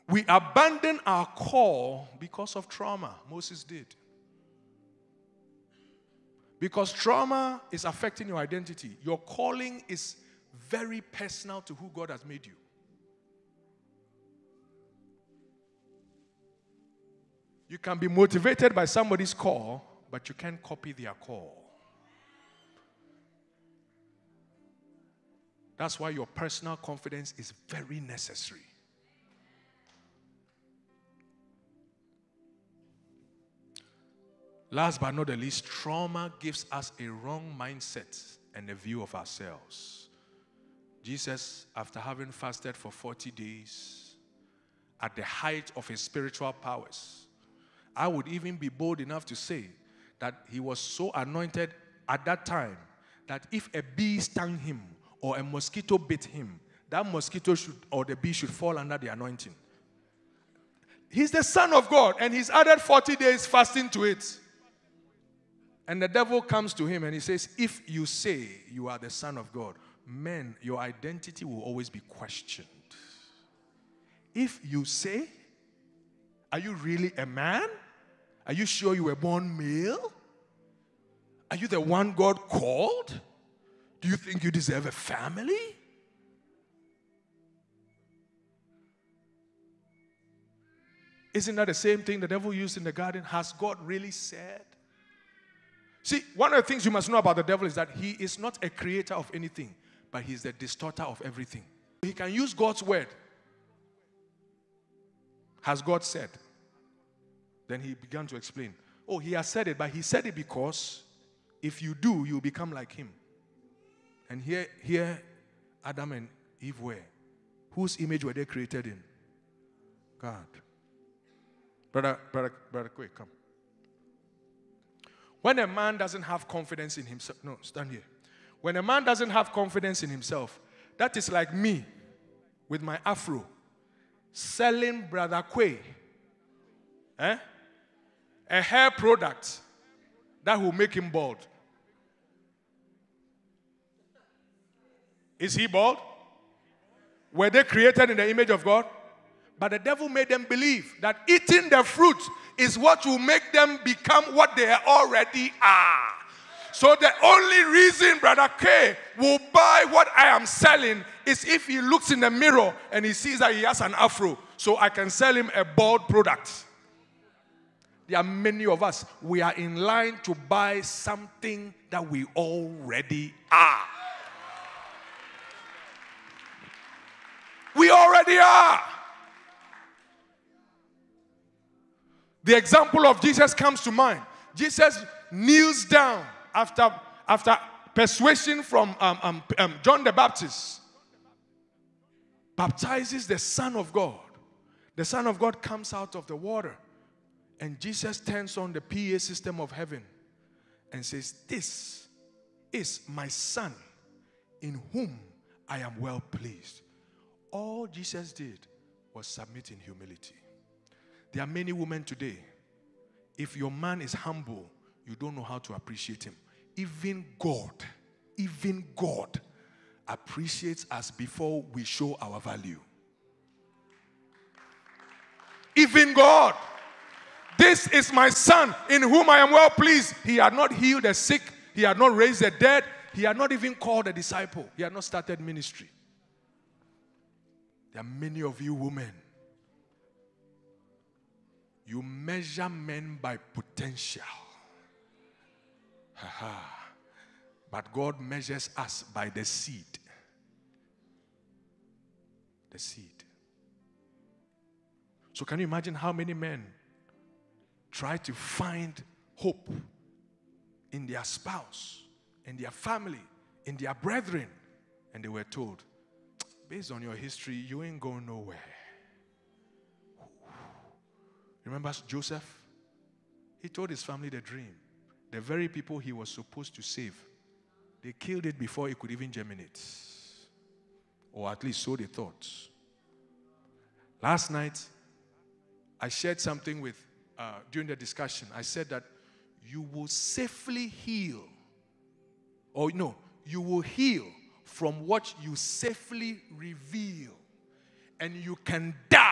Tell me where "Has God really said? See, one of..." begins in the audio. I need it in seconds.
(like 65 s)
93 s.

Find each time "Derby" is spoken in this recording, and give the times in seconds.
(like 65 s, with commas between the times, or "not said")
not said.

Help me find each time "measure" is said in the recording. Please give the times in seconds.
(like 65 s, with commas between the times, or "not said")
242 s, 248 s.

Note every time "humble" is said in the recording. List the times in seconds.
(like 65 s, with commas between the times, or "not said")
214 s.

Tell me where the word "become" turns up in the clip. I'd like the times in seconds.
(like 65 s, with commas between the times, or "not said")
112 s, 153 s.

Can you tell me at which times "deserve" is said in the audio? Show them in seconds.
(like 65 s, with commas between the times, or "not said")
84 s.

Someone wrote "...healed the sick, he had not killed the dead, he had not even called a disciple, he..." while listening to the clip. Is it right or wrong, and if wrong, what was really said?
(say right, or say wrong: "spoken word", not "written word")
wrong: "raised", not "killed".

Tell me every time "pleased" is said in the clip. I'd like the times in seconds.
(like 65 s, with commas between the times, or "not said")
206 s, 229 s.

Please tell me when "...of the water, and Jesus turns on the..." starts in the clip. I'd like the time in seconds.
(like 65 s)
196 s.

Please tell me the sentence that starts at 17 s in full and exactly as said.
You can be motivated by somebody's call, but you can't copy their call.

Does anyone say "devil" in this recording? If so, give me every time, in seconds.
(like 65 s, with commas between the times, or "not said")
66 s, 92 s, 97 s, 149 s.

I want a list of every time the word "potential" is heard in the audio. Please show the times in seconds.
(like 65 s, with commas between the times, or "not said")
243 s.